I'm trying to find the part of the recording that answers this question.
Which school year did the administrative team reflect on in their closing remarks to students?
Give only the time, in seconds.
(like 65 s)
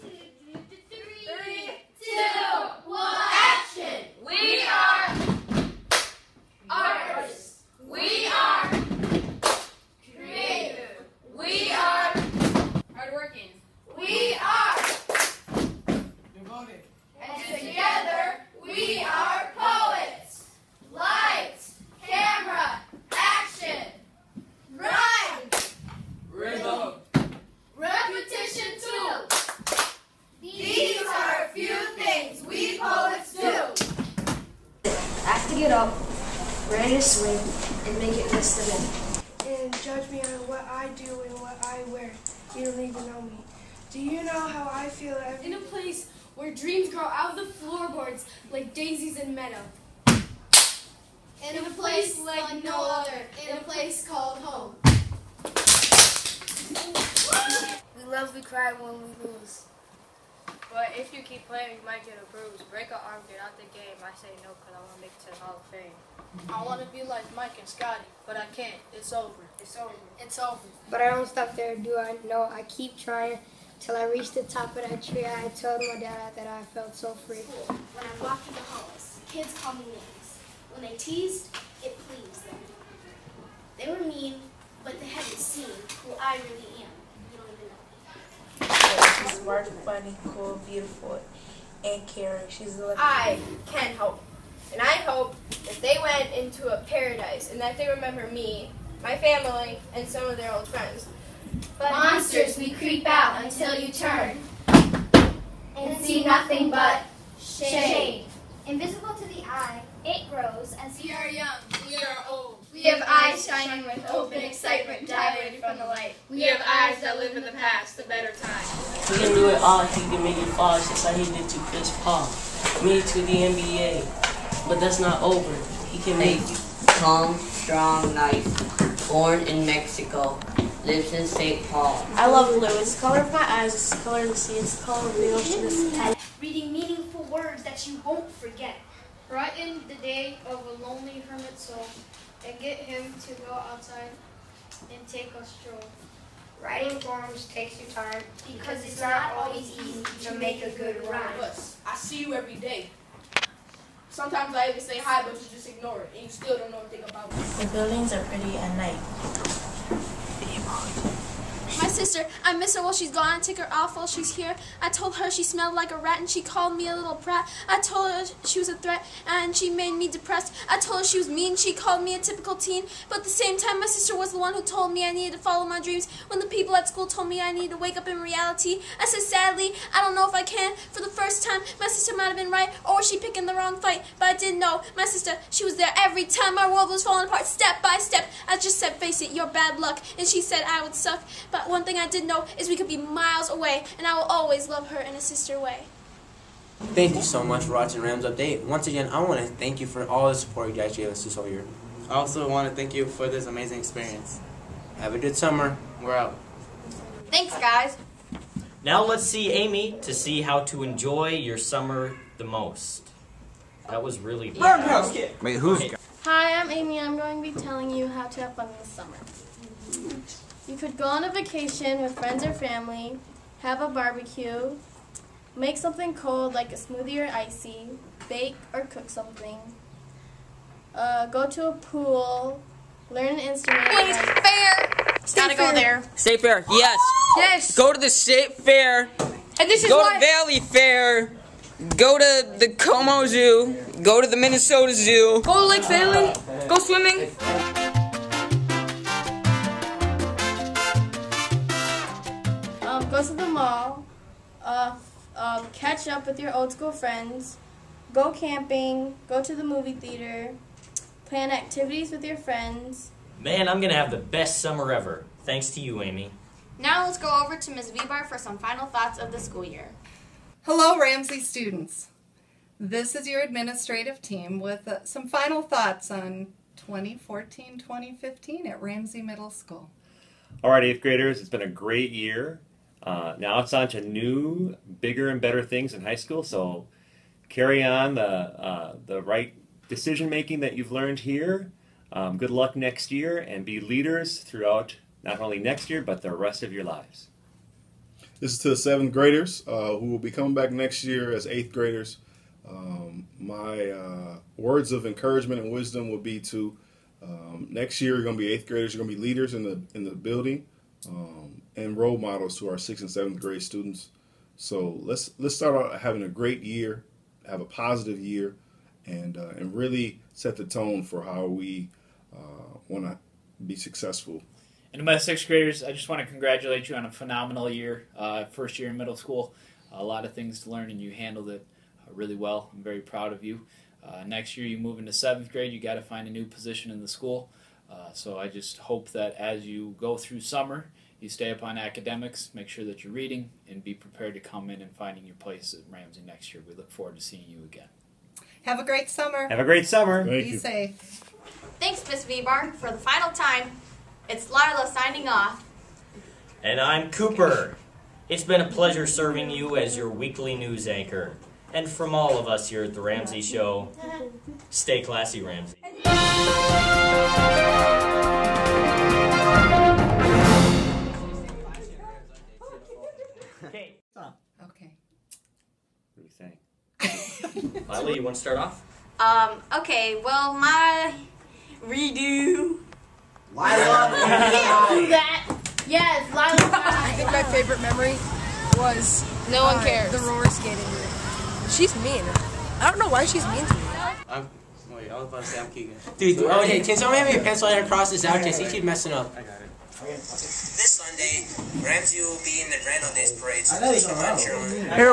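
276 s.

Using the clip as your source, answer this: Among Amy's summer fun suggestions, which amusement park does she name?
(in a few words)
Valleyfair.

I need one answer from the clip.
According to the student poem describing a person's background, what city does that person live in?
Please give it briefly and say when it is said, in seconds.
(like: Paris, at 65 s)
St. Paul, at 131 s.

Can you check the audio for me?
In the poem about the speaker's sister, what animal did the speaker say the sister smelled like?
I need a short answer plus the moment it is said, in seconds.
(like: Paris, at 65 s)
a rat, at 165 s.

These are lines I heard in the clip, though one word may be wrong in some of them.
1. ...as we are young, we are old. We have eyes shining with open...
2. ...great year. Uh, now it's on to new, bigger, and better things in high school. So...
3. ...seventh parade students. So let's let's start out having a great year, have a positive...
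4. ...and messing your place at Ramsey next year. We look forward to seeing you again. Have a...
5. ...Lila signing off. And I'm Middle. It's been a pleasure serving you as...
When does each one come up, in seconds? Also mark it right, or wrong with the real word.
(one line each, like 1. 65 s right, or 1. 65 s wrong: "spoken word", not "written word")
1. 110 s right
2. 281 s right
3. 313 s wrong: "grade", not "parade"
4. 344 s wrong: "finding", not "messing"
5. 354 s wrong: "Cooper", not "Middle".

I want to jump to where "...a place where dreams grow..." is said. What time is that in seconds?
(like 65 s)
45 s.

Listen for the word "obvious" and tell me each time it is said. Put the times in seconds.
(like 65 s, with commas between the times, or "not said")
not said.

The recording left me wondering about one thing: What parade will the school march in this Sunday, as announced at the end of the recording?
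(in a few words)
Grand Old Days.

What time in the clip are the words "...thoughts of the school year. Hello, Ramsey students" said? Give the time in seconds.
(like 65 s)
268 s.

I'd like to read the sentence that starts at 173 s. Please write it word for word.
But at the same time, my sister was the one who told me I needed to follow my dreams.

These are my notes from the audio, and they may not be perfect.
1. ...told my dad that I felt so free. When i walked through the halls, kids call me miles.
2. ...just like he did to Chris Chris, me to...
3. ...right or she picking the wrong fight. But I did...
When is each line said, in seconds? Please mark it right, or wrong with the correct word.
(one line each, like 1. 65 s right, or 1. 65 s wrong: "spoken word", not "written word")
1. 75 s wrong: "names", not "miles"
2. 120 s wrong: "Paul", not "Chris"
3. 182 s right.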